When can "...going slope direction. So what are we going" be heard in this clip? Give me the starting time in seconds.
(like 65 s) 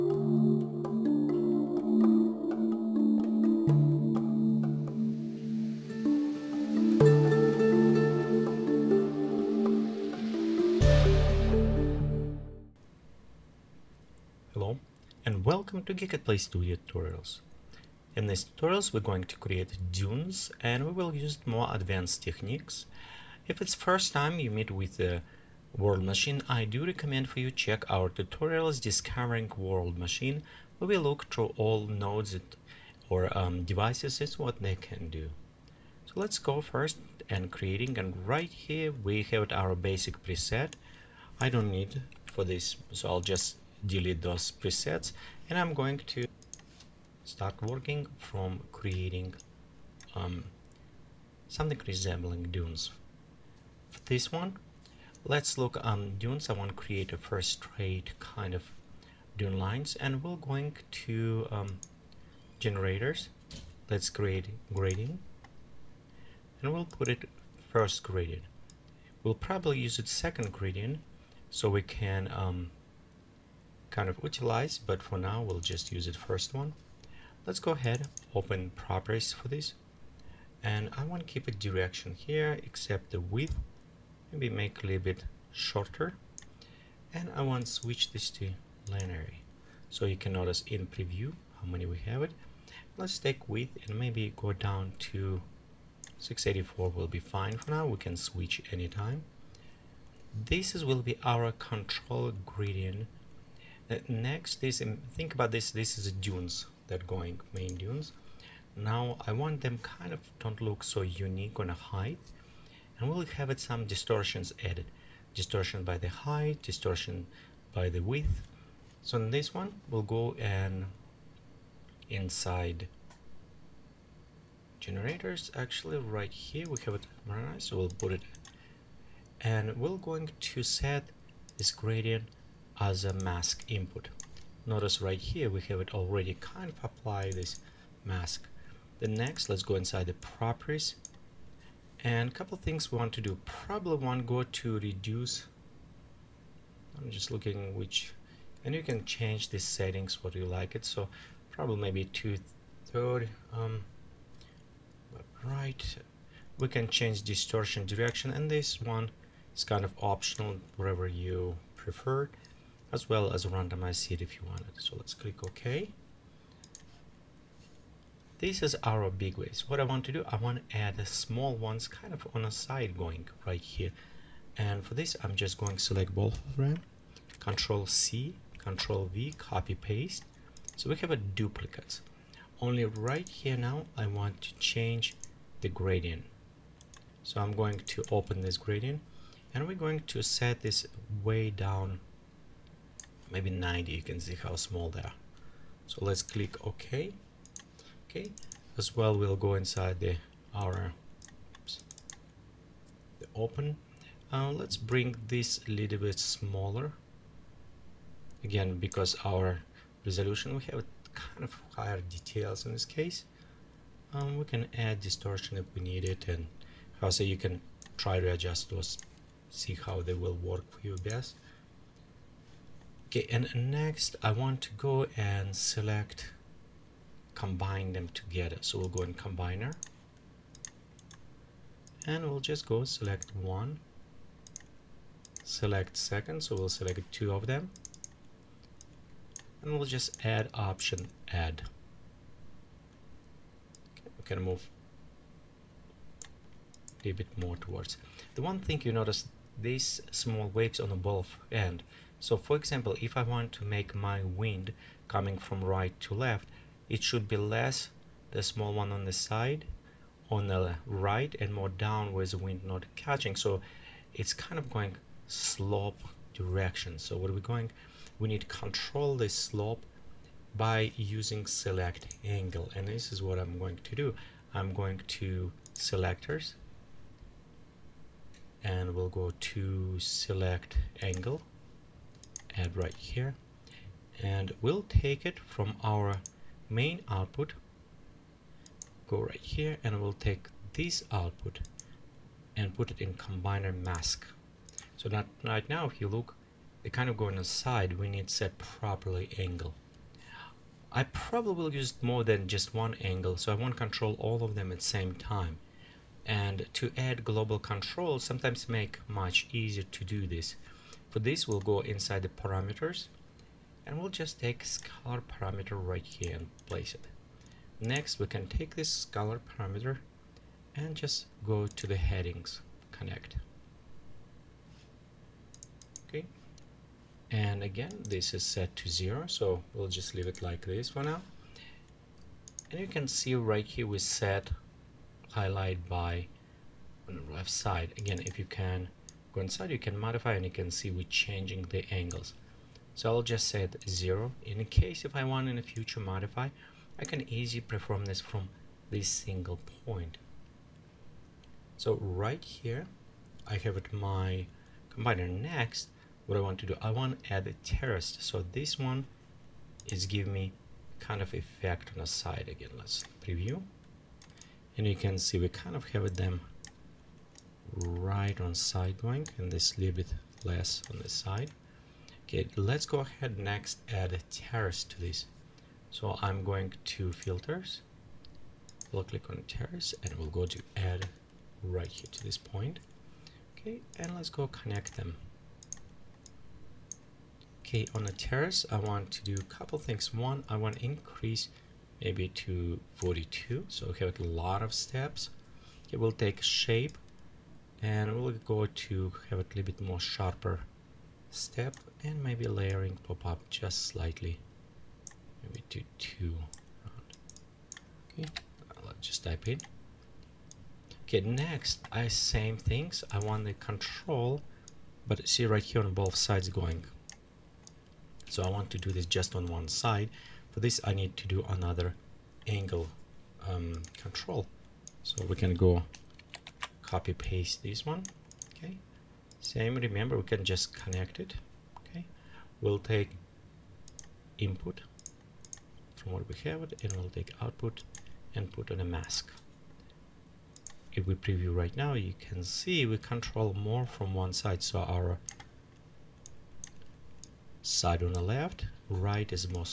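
264 s.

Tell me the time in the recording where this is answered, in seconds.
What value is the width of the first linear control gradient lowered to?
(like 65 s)
96 s.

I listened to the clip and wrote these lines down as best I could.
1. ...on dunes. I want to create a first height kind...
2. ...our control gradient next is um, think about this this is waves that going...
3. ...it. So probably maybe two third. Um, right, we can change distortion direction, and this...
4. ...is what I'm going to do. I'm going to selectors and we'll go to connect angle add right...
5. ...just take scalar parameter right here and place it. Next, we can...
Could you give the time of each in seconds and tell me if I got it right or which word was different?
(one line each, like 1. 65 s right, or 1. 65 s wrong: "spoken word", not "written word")
1. 55 s wrong: "straight", not "height"
2. 101 s wrong: "dunes", not "waves"
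3. 150 s right
4. 273 s wrong: "select", not "connect"
5. 314 s right.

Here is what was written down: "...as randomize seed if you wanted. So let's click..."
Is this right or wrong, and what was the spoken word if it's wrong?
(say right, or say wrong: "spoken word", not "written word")
right.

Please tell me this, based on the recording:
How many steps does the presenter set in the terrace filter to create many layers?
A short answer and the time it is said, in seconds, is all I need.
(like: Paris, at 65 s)
42, at 392 s.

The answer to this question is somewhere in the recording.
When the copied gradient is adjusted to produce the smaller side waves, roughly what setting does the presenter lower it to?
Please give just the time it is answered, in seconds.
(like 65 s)
193 s.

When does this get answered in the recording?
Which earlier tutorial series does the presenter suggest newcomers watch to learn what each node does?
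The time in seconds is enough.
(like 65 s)
28 s.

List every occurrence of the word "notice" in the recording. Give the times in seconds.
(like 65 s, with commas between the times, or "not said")
90 s, 134 s, 248 s.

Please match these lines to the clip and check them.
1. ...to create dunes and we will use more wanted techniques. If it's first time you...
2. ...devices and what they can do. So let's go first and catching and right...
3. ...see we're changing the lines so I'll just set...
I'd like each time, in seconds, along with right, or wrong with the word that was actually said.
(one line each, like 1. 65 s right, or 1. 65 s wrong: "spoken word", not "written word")
1. 19 s wrong: "advanced", not "wanted"
2. 33 s wrong: "creating", not "catching"
3. 340 s wrong: "angles", not "lines".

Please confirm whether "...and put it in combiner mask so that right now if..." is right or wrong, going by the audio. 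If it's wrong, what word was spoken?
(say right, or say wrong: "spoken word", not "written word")
right.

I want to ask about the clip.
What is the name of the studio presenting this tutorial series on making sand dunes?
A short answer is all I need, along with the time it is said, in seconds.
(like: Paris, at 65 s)
Geekatplay Studio, at 16 s.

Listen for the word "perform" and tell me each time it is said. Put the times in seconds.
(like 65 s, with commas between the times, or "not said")
347 s.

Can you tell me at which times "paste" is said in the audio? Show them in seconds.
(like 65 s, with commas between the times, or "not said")
179 s, 427 s.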